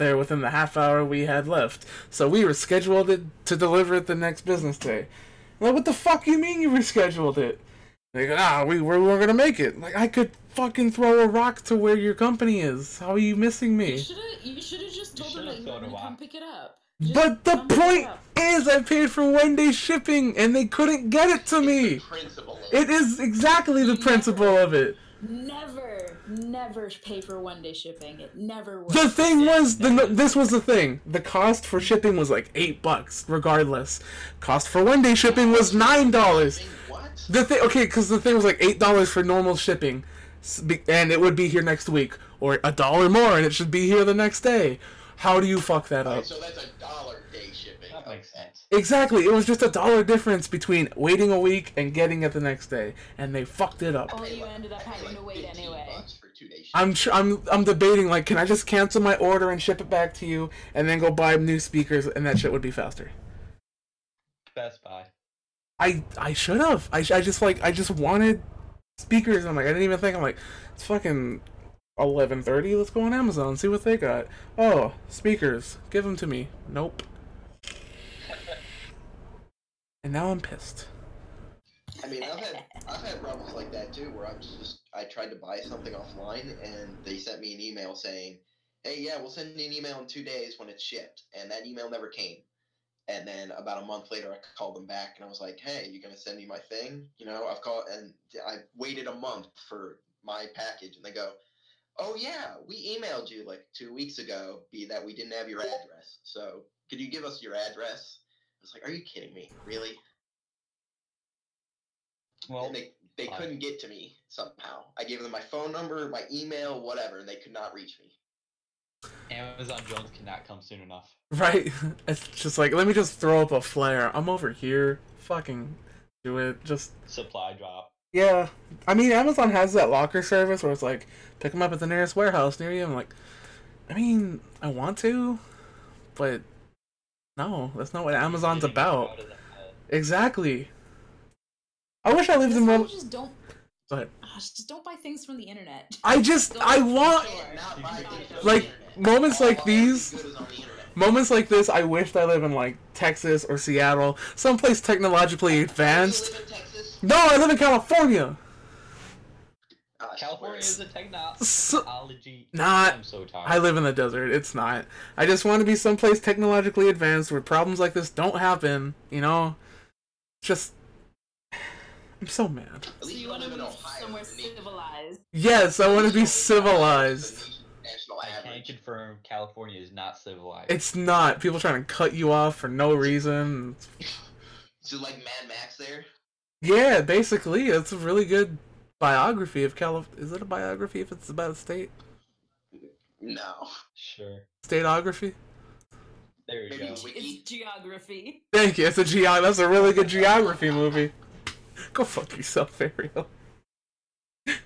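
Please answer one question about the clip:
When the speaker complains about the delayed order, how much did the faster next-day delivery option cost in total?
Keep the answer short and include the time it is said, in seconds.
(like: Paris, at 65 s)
$9, at 35 s.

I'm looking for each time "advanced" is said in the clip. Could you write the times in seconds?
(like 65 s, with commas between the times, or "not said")
155 s, 166 s.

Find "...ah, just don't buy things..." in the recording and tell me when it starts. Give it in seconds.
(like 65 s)
144 s.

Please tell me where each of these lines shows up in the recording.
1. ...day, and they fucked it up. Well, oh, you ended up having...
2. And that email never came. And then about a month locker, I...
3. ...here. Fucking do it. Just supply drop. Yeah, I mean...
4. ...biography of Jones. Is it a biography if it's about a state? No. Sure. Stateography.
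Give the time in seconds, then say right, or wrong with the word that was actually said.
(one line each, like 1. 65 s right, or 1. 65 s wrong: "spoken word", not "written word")
1. 52 s right
2. 91 s wrong: "later", not "locker"
3. 124 s right
4. 188 s wrong: "California", not "Jones".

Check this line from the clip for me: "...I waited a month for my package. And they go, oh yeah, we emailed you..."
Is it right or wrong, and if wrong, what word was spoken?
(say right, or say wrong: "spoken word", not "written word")
right.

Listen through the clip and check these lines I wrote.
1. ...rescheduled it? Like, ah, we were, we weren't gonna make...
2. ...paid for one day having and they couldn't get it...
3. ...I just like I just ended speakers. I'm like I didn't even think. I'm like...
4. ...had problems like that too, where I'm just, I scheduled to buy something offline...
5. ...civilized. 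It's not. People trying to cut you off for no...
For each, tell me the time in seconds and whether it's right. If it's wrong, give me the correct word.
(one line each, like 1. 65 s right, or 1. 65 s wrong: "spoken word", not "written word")
1. 6 s right
2. 18 s wrong: "shipping", not "having"
3. 66 s wrong: "wanted", not "ended"
4. 83 s wrong: "tried", not "scheduled"
5. 180 s right.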